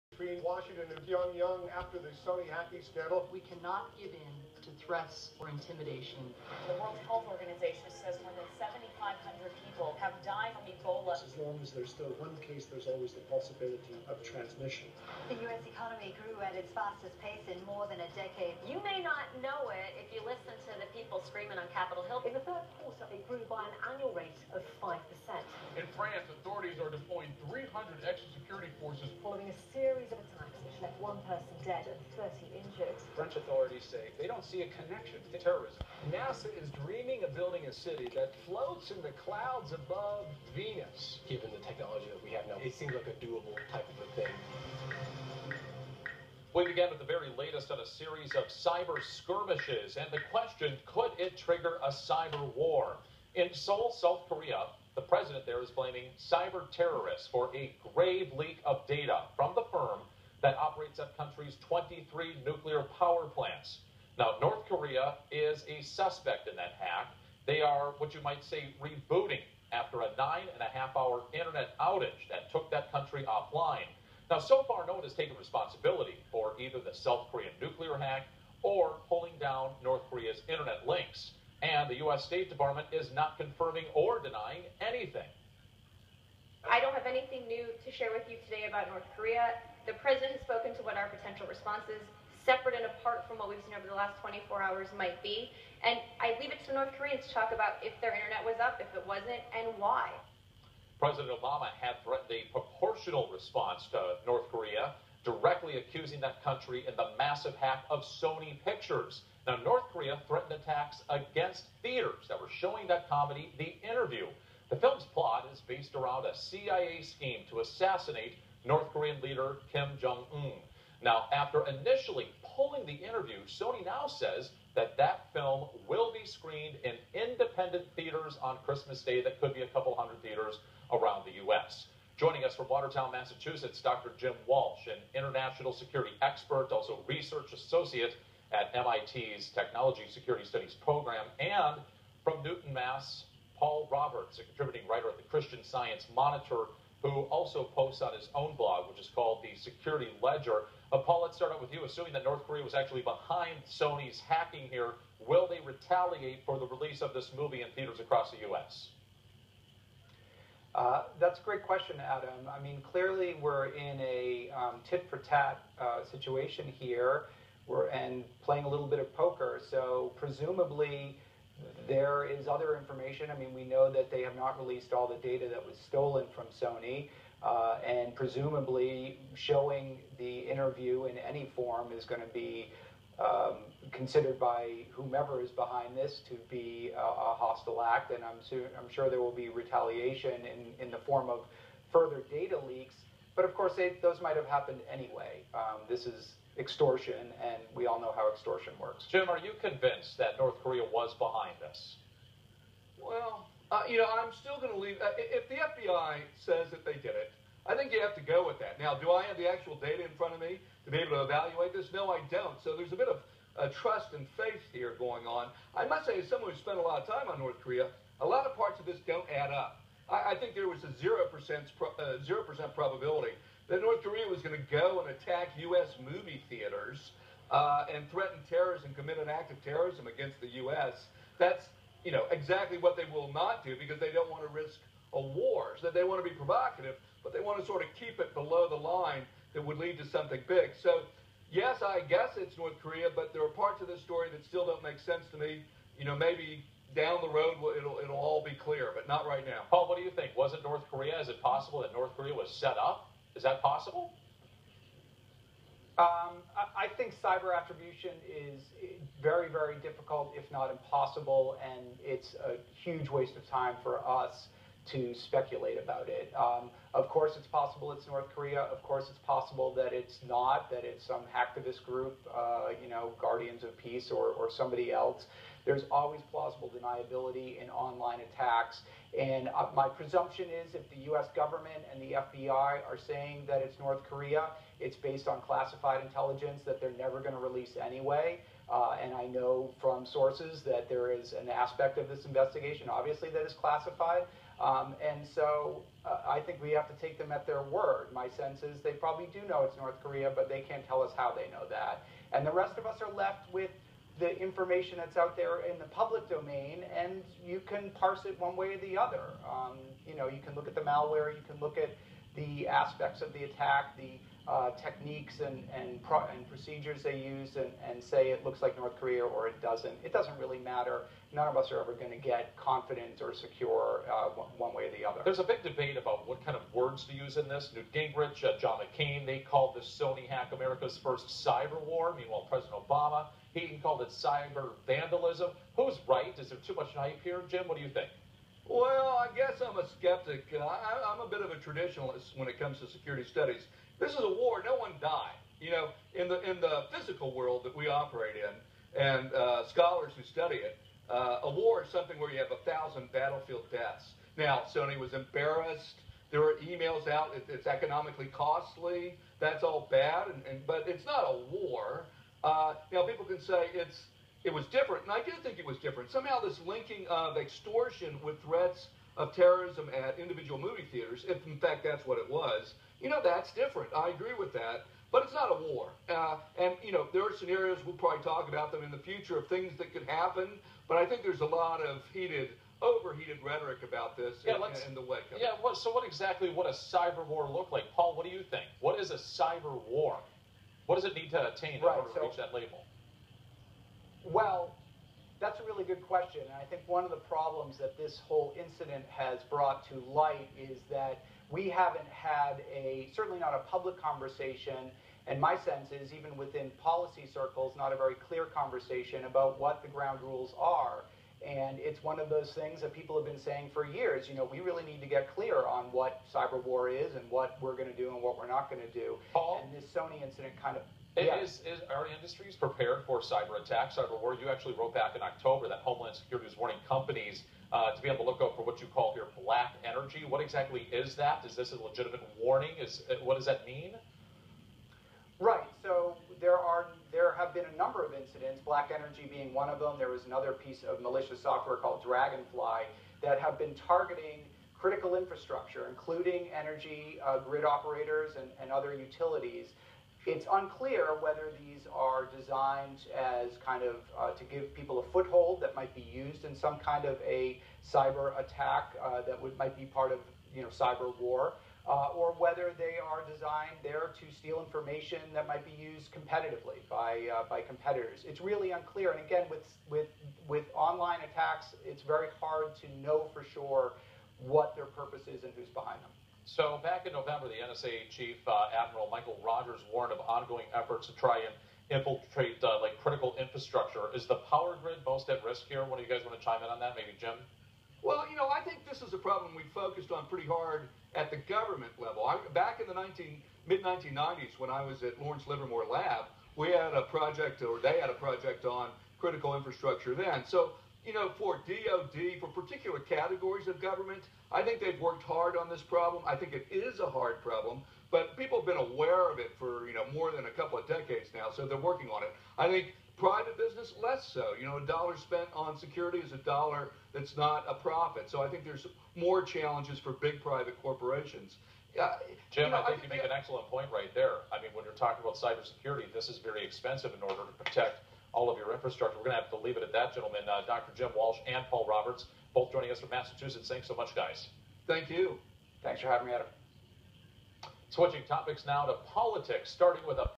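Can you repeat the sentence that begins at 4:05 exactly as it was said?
You know, maybe down the road it'll it'll all be clear, but not right now.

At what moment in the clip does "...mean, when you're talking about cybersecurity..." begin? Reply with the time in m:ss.
8:44.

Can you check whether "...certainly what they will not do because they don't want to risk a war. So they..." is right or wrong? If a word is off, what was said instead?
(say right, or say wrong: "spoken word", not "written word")
wrong: "exactly", not "certainly".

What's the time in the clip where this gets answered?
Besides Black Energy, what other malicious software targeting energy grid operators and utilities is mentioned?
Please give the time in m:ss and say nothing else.
7:22.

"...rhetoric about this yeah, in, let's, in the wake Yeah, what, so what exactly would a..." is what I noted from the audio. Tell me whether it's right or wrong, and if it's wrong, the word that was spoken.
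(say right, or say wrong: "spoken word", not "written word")
right.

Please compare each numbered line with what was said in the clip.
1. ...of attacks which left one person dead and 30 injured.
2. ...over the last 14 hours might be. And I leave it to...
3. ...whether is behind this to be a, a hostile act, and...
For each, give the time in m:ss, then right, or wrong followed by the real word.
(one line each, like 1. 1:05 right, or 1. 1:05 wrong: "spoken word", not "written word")
1. 0:30 right
2. 1:33 wrong: "24", not "14"
3. 3:04 wrong: "whomever", not "whether".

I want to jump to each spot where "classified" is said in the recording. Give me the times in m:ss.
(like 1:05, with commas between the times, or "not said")
4:45, 4:53.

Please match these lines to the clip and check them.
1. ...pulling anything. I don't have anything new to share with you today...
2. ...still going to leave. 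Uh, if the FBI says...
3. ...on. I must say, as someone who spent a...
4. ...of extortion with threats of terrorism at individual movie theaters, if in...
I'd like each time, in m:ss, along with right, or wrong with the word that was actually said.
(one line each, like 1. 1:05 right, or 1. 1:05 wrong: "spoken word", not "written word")
1. 1:24 wrong: "denying", not "pulling"
2. 3:24 right
3. 3:35 right
4. 6:07 right.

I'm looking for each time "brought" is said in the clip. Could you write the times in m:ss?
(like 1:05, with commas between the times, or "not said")
6:39.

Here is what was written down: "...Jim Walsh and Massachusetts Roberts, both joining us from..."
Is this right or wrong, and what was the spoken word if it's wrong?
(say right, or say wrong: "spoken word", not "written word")
wrong: "Paul", not "Massachusetts".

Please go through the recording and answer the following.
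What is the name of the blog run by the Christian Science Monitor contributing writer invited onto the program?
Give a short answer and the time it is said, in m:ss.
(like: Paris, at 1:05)
Security Ledger, at 2:29.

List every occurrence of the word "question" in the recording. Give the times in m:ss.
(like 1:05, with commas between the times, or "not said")
0:50, 2:41, 6:36.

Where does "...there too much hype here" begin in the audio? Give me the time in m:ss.
5:36.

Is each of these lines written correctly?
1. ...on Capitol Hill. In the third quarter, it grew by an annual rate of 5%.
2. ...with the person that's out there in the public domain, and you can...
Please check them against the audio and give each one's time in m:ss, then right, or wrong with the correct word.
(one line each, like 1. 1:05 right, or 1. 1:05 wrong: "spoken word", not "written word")
1. 0:21 right
2. 5:03 wrong: "information", not "person".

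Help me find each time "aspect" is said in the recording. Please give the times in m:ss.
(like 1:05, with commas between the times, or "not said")
4:51, 5:12.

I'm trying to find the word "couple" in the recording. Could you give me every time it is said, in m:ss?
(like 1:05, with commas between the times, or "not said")
2:09, 8:30.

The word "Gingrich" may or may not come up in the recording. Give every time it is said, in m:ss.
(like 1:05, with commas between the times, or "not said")
5:27.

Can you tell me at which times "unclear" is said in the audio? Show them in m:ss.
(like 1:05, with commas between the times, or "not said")
7:30, 7:48.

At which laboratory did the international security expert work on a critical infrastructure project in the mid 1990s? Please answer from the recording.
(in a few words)
Lawrence Livermore Lab.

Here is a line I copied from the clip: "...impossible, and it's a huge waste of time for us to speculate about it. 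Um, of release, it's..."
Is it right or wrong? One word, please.
wrong.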